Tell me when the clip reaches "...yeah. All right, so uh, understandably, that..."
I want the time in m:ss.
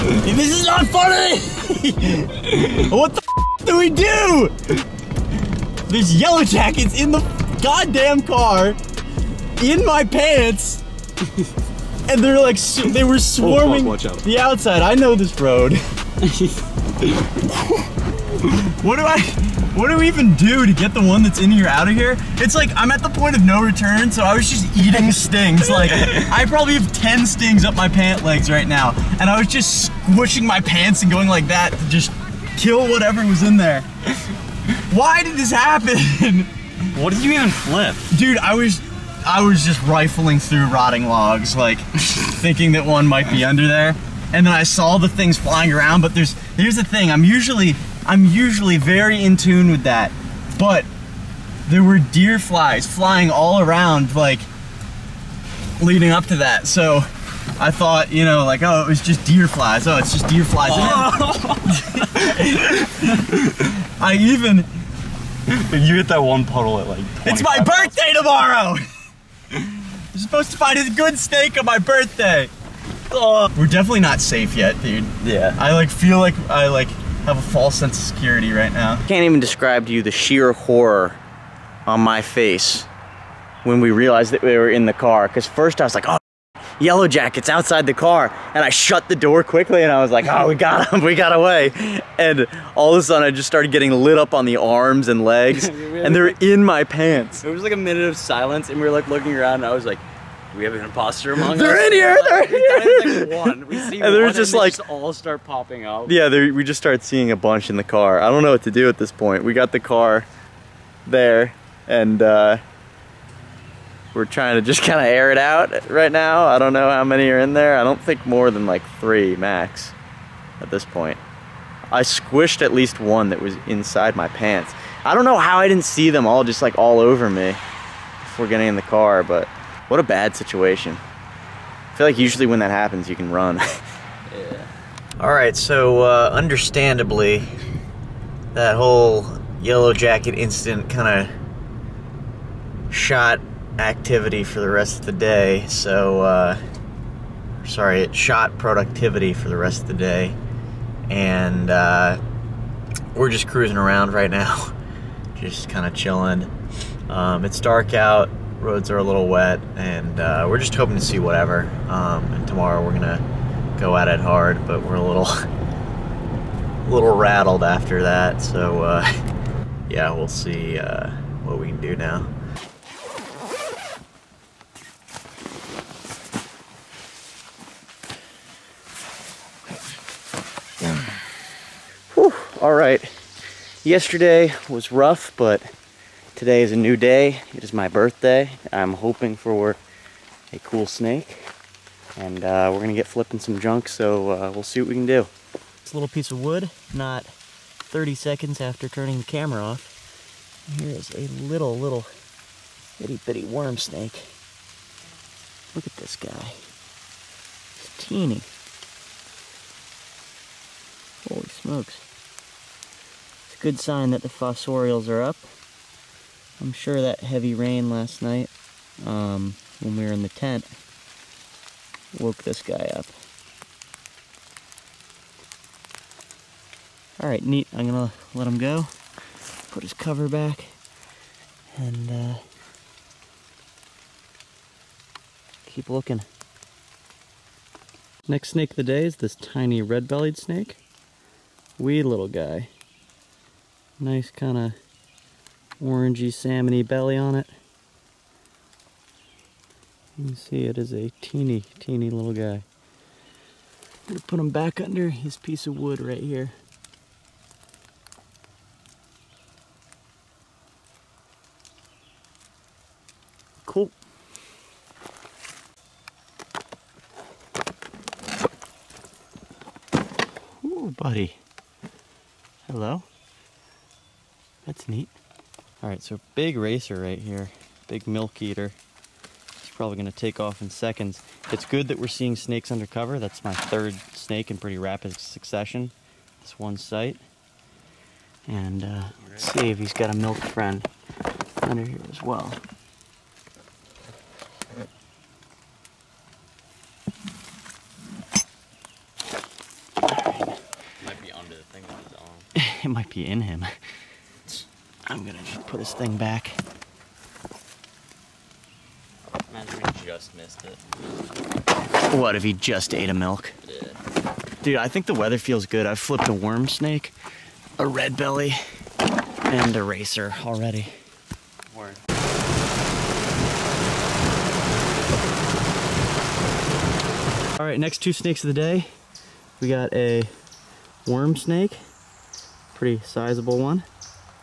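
2:13.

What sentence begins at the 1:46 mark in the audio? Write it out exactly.
Yeah, we just start seeing a bunch in the car.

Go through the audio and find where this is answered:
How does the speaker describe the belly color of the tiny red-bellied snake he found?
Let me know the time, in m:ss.
4:05.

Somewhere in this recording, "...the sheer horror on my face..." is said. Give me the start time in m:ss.
1:20.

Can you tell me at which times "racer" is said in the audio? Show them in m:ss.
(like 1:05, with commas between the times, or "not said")
4:36, 5:19.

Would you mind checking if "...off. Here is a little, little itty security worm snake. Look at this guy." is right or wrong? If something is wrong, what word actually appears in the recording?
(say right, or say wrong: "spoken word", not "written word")
wrong: "bitty", not "security".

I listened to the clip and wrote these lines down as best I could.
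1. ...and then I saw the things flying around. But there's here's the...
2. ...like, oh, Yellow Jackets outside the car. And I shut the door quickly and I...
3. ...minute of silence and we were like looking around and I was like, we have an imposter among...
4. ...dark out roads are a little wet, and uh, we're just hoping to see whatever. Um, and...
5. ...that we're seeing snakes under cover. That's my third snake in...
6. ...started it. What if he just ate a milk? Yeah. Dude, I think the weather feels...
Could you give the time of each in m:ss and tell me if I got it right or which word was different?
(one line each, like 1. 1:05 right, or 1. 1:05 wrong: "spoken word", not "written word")
1. 0:44 right
2. 1:25 right
3. 1:37 right
4. 2:37 right
5. 4:41 right
6. 5:10 wrong: "missed", not "started".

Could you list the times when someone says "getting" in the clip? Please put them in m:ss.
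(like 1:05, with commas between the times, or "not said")
1:33, 2:08.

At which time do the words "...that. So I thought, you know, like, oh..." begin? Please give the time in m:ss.
0:56.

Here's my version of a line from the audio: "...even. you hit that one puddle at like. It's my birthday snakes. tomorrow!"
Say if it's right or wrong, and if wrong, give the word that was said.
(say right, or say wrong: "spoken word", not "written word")
wrong: "miles", not "snakes".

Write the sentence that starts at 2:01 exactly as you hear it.
I squished at least one that was inside my pants.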